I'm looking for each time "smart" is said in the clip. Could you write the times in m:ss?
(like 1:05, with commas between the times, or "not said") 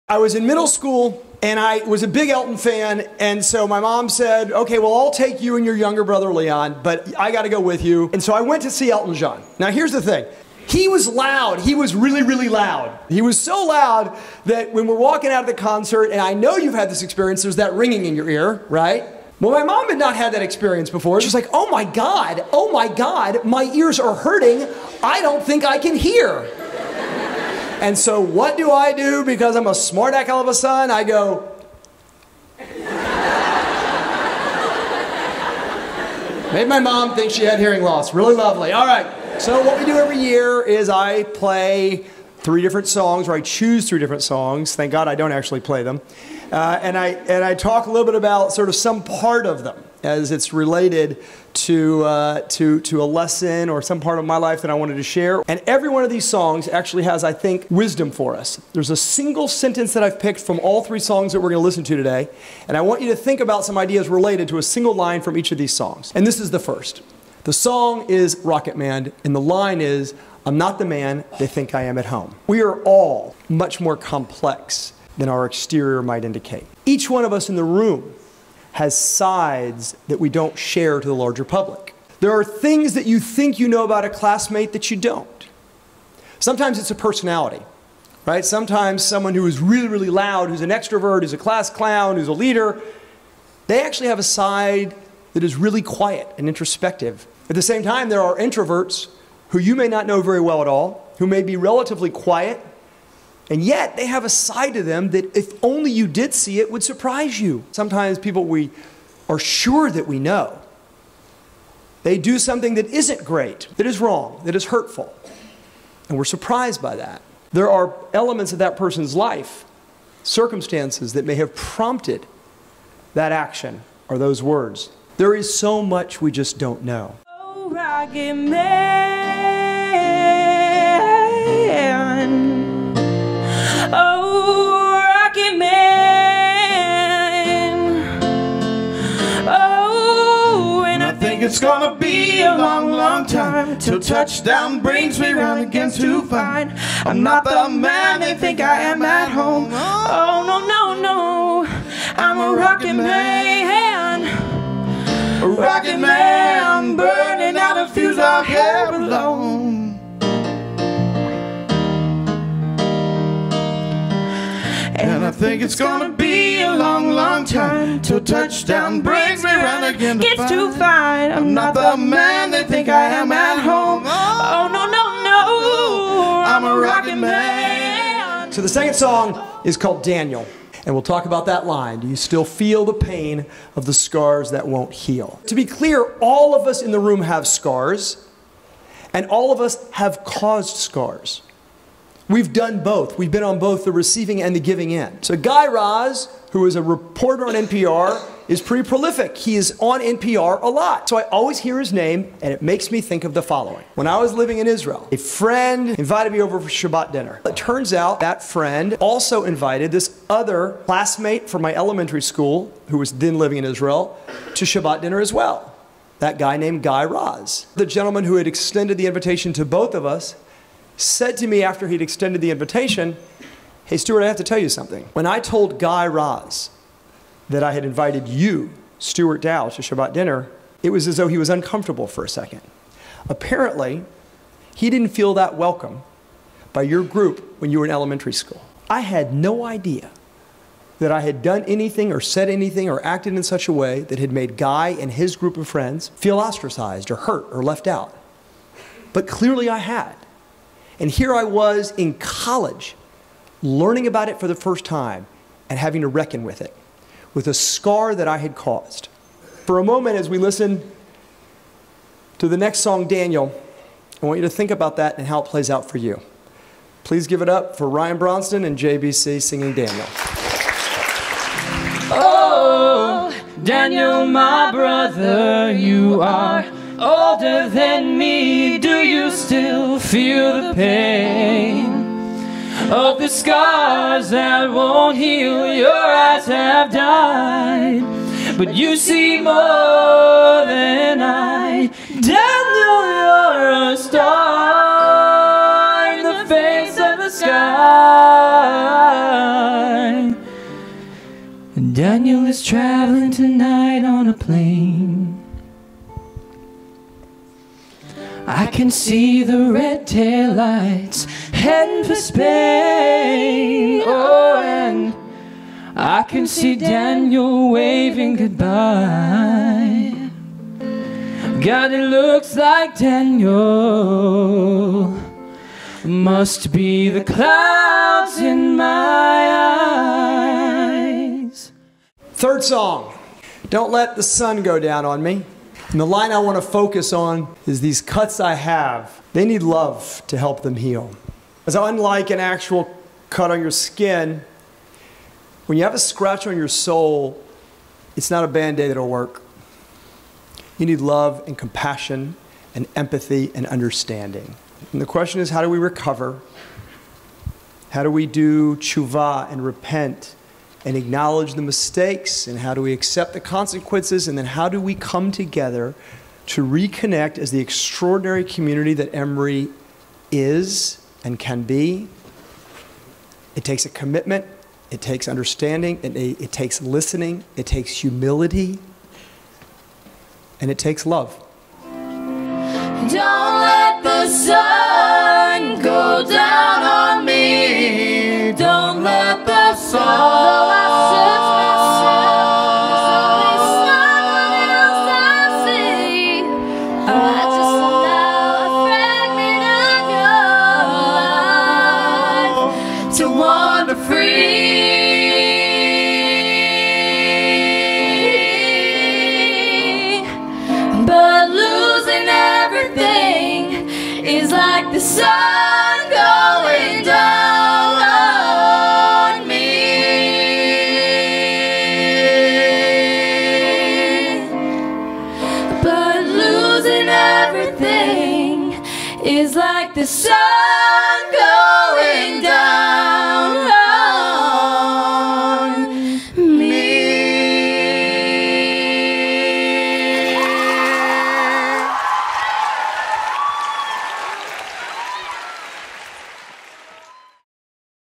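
0:29.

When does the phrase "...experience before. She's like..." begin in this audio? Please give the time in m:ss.
0:20.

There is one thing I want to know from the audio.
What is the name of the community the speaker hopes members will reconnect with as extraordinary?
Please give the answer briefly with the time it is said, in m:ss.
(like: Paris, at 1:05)
Emery, at 6:09.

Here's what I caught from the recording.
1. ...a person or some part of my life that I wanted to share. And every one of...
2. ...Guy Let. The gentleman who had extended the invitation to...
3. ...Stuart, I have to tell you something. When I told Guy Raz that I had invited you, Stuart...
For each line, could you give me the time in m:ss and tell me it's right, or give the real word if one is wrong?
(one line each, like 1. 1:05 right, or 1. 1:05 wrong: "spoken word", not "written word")
1. 0:53 wrong: "lesson", not "person"
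2. 3:36 wrong: "Raz", not "Let"
3. 3:43 right.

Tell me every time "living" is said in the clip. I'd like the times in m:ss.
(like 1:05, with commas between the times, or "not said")
3:24, 3:33.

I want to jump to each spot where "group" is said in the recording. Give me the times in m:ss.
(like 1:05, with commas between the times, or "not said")
3:57, 4:05.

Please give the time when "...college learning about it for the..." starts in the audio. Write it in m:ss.
4:12.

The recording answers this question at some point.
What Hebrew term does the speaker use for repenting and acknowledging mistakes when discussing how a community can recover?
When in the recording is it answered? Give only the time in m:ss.
5:58.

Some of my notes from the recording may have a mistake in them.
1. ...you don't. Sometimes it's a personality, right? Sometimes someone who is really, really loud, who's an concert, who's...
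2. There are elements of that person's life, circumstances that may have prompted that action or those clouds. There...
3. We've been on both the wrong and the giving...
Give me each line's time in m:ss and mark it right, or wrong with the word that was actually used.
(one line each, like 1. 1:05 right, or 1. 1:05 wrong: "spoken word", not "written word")
1. 1:24 wrong: "extrovert", not "concert"
2. 1:57 wrong: "words", not "clouds"
3. 3:13 wrong: "receiving", not "wrong".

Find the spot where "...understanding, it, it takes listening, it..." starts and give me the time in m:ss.
6:15.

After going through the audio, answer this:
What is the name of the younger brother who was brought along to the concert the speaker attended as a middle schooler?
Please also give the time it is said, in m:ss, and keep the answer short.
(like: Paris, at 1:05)
Leon, at 0:06.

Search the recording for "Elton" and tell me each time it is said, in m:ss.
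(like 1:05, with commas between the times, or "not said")
0:02, 0:08.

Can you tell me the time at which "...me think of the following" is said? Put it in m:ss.
3:22.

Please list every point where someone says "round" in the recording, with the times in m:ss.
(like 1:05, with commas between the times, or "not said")
2:25, 2:49.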